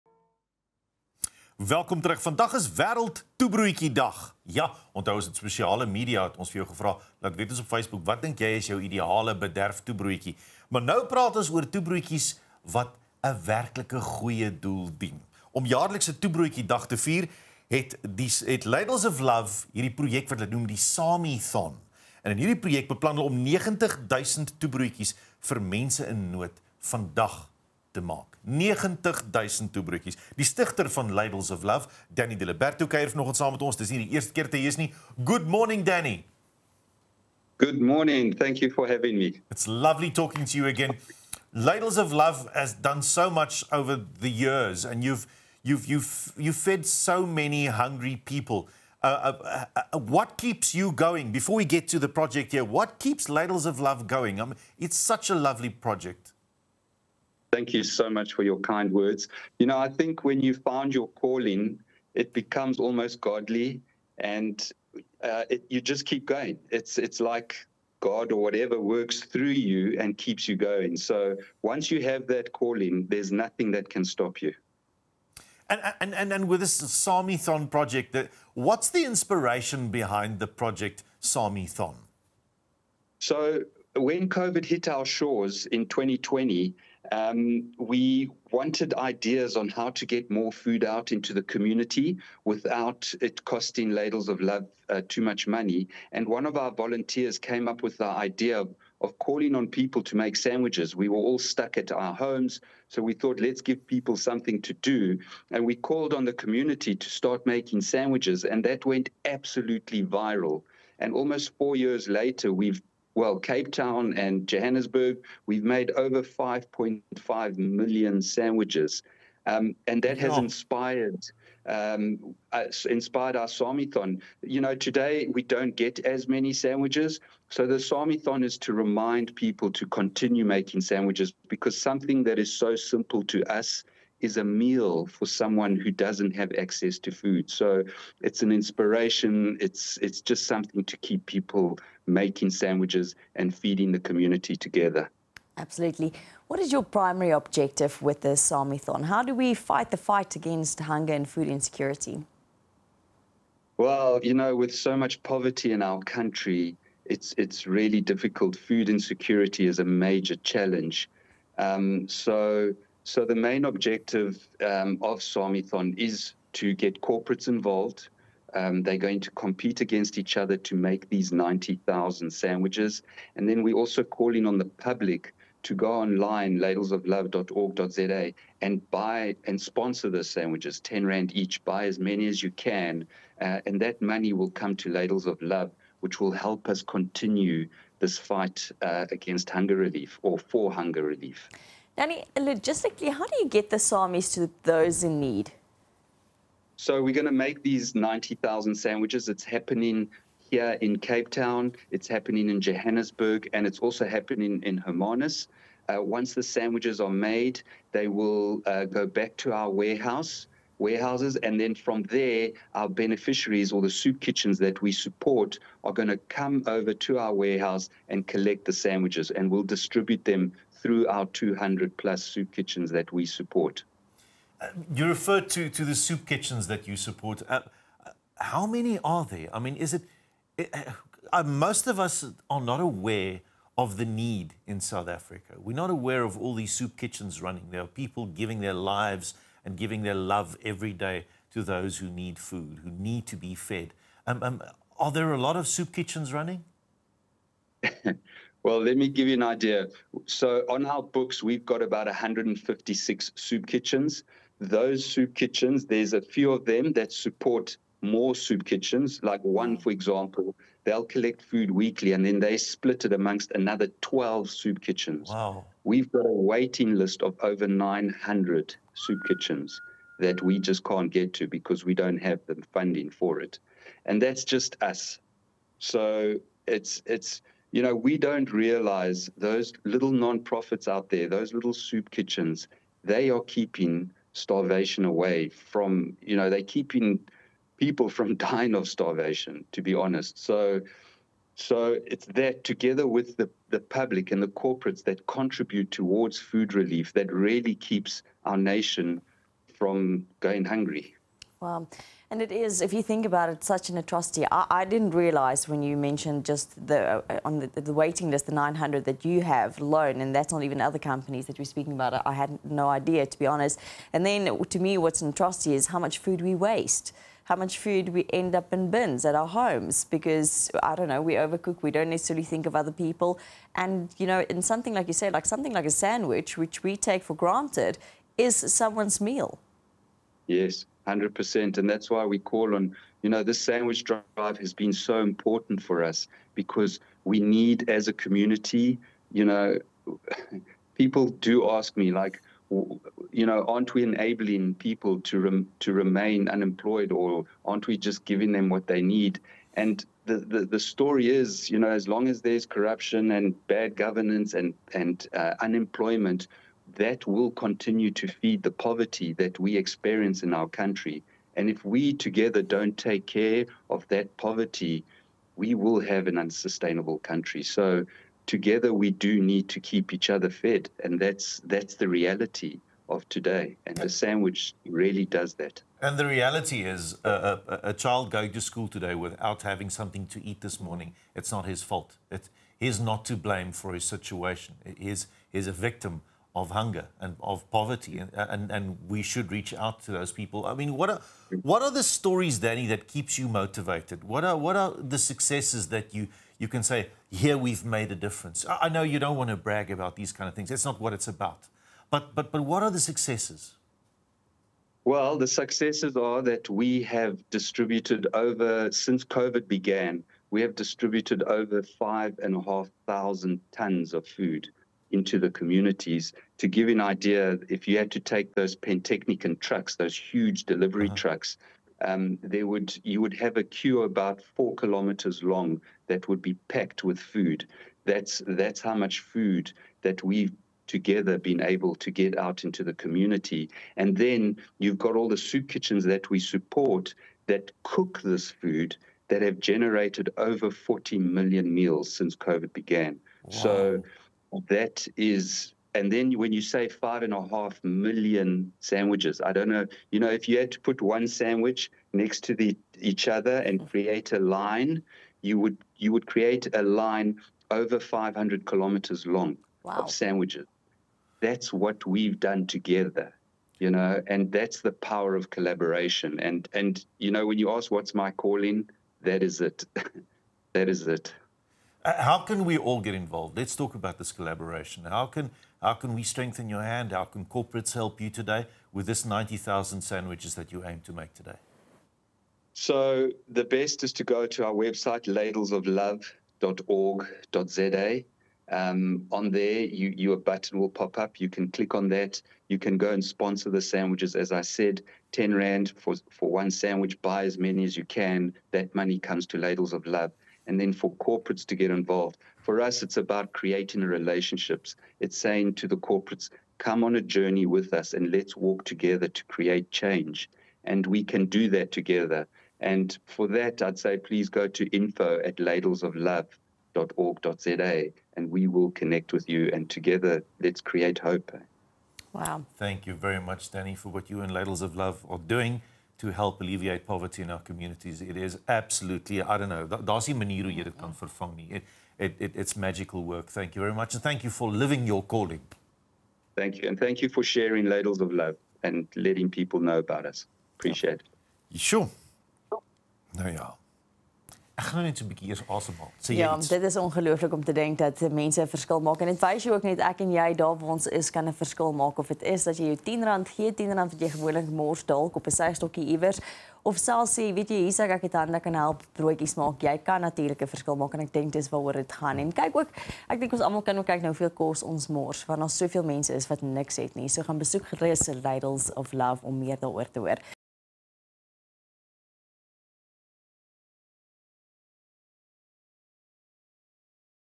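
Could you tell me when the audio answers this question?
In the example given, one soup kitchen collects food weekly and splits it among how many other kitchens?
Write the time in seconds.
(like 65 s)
263 s.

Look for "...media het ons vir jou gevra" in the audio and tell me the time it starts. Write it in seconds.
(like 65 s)
5 s.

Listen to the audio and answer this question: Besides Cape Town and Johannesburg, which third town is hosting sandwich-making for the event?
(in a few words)
Hermanus.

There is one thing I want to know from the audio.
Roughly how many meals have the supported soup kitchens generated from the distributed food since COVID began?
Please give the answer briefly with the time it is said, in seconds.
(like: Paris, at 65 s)
40 million, at 440 s.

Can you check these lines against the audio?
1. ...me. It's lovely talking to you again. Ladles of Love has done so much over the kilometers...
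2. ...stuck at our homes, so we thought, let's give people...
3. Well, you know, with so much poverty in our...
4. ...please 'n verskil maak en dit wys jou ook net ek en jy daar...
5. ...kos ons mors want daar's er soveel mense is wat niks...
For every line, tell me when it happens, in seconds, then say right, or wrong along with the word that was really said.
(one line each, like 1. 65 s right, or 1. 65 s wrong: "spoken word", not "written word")
1. 39 s wrong: "years", not "kilometers"
2. 101 s right
3. 153 s right
4. 548 s wrong: "mense", not "please"
5. 564 s right.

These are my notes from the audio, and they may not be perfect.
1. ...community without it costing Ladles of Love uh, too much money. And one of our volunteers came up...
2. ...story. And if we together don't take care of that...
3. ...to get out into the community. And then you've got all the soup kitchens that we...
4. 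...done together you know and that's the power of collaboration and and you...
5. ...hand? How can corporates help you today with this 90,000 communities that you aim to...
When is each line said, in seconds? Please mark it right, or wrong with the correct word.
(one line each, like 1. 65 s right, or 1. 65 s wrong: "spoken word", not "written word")
1. 91 s right
2. 360 s wrong: "country", not "story"
3. 431 s right
4. 462 s right
5. 476 s wrong: "sandwiches", not "communities".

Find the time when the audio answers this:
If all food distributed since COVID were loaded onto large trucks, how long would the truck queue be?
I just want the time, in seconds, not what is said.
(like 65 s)
424 s.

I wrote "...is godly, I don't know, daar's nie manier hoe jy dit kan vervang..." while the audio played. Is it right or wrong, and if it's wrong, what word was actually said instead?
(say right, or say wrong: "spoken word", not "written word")
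wrong: "absolutely", not "godly".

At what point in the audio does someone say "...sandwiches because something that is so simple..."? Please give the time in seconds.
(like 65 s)
130 s.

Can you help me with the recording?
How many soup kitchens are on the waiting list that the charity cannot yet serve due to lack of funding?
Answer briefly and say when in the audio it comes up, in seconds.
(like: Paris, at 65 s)
over 900, at 267 s.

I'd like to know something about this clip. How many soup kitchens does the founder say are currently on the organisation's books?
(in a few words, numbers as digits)
156.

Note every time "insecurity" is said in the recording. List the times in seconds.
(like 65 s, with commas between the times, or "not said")
151 s, 158 s.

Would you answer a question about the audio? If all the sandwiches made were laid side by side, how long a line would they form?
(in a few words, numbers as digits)
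over 500 kilometres.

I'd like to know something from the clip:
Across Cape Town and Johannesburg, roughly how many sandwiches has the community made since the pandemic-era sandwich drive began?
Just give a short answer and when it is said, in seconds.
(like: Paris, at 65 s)
5.5 million, at 116 s.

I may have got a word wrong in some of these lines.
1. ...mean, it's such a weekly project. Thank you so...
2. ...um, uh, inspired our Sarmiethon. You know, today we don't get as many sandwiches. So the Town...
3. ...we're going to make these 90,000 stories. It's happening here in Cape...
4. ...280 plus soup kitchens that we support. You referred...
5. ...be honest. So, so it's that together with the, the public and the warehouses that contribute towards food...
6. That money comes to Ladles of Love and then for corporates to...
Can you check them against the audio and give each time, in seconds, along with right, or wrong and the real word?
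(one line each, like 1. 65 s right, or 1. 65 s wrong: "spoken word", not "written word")
1. 54 s wrong: "lovely", not "weekly"
2. 121 s wrong: "Sarmiethon", not "Town"
3. 197 s wrong: "sandwiches", not "stories"
4. 221 s wrong: "200", not "280"
5. 289 s wrong: "corporates", not "warehouses"
6. 498 s right.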